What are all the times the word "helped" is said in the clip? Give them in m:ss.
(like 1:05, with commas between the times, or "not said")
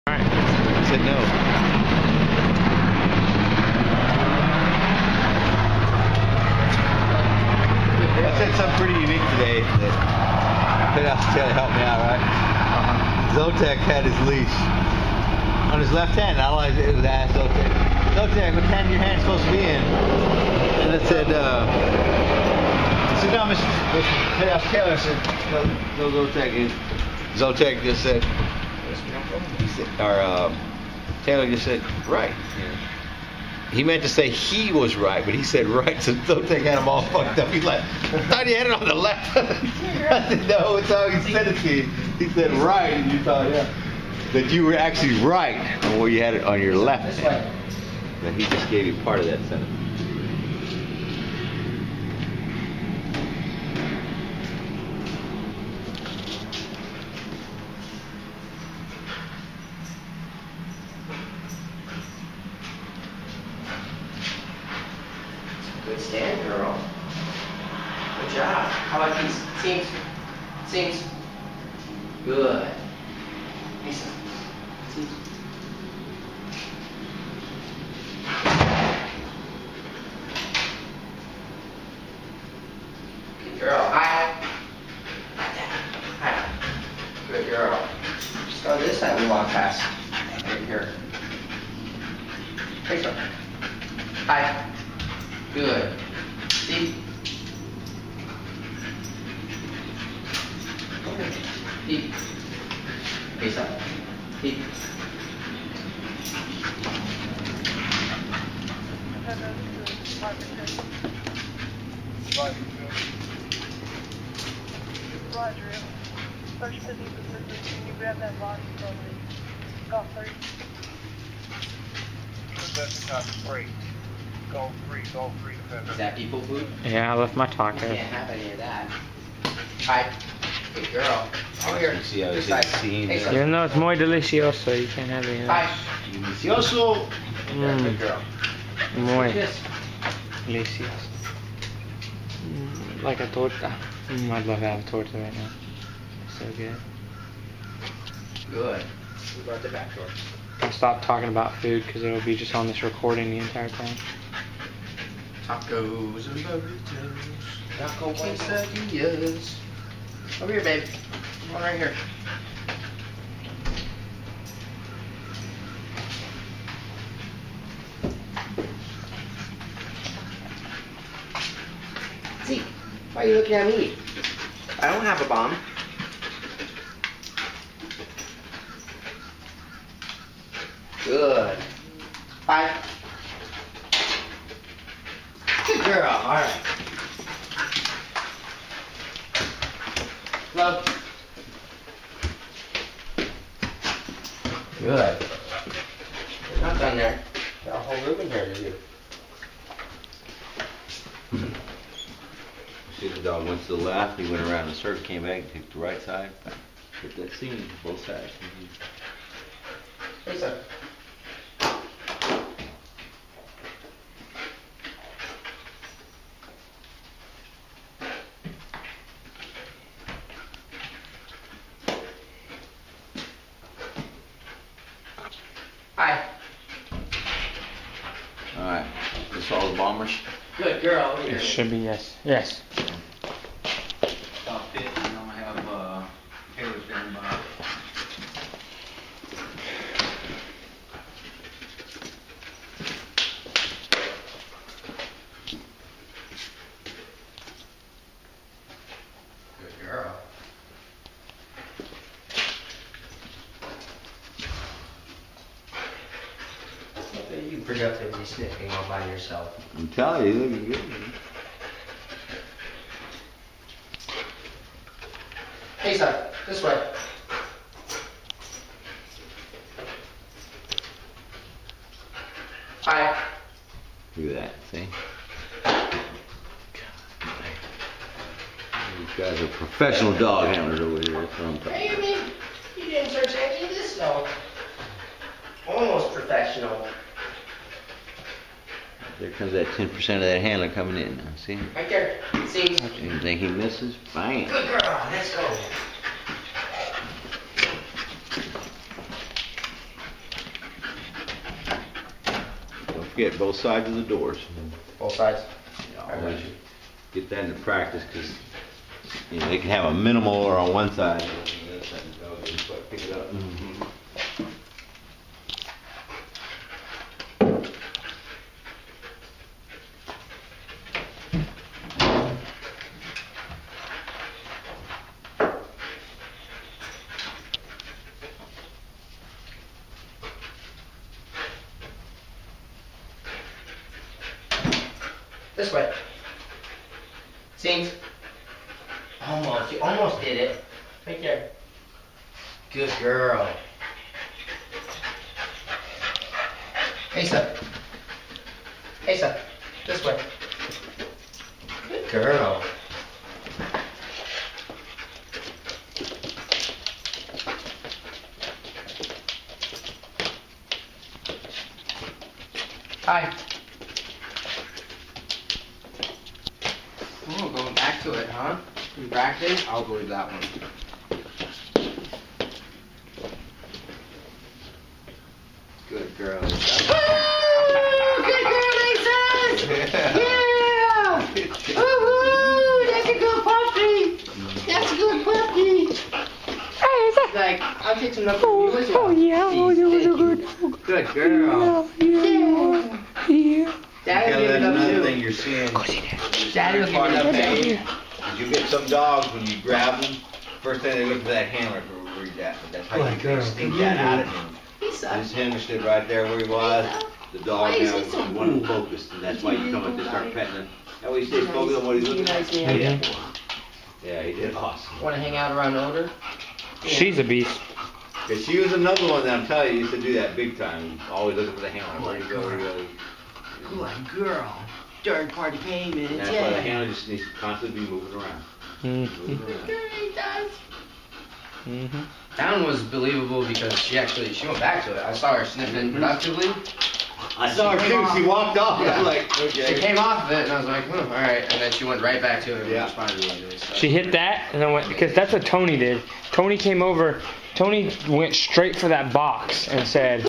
0:11.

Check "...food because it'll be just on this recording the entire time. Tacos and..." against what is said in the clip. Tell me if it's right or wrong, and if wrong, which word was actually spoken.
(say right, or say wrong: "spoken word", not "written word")
right.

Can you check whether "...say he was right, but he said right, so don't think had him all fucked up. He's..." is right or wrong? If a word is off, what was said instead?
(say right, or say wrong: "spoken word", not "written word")
right.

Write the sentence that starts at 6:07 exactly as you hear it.
Cool, oh, going back to it, huh?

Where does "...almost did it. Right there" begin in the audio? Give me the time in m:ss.
5:39.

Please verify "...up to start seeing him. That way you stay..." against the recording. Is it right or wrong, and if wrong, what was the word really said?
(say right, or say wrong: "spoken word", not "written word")
wrong: "petting", not "seeing".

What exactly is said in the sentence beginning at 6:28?
Oh, oh yeah, oh, that was good.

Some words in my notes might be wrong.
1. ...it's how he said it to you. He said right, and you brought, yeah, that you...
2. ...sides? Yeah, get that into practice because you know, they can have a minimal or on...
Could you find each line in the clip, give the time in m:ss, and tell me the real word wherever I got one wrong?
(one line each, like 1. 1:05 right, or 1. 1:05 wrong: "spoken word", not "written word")
1. 0:40 wrong: "thought", not "brought"
2. 5:05 right.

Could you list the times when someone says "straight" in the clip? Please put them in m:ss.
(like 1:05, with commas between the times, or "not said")
7:28.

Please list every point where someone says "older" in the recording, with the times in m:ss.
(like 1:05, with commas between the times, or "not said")
6:55.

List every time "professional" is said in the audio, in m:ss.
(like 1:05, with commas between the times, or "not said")
4:39, 4:46.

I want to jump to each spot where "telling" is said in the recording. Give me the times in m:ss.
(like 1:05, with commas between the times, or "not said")
4:19, 6:59.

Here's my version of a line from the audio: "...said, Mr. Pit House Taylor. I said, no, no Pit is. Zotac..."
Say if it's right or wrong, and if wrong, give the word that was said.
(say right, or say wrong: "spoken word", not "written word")
wrong: "Zotac", not "Pit".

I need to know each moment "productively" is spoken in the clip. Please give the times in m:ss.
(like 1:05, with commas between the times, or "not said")
4:17, 7:15.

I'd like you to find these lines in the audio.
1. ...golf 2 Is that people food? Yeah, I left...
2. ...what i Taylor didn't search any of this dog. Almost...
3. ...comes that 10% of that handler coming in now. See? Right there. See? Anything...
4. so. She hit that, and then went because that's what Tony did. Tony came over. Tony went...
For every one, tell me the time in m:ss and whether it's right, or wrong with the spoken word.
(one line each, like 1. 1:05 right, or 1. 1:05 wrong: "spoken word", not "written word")
1. 2:05 wrong: "3", not "2"
2. 4:41 wrong: "You", not "Taylor"
3. 4:49 right
4. 7:23 right.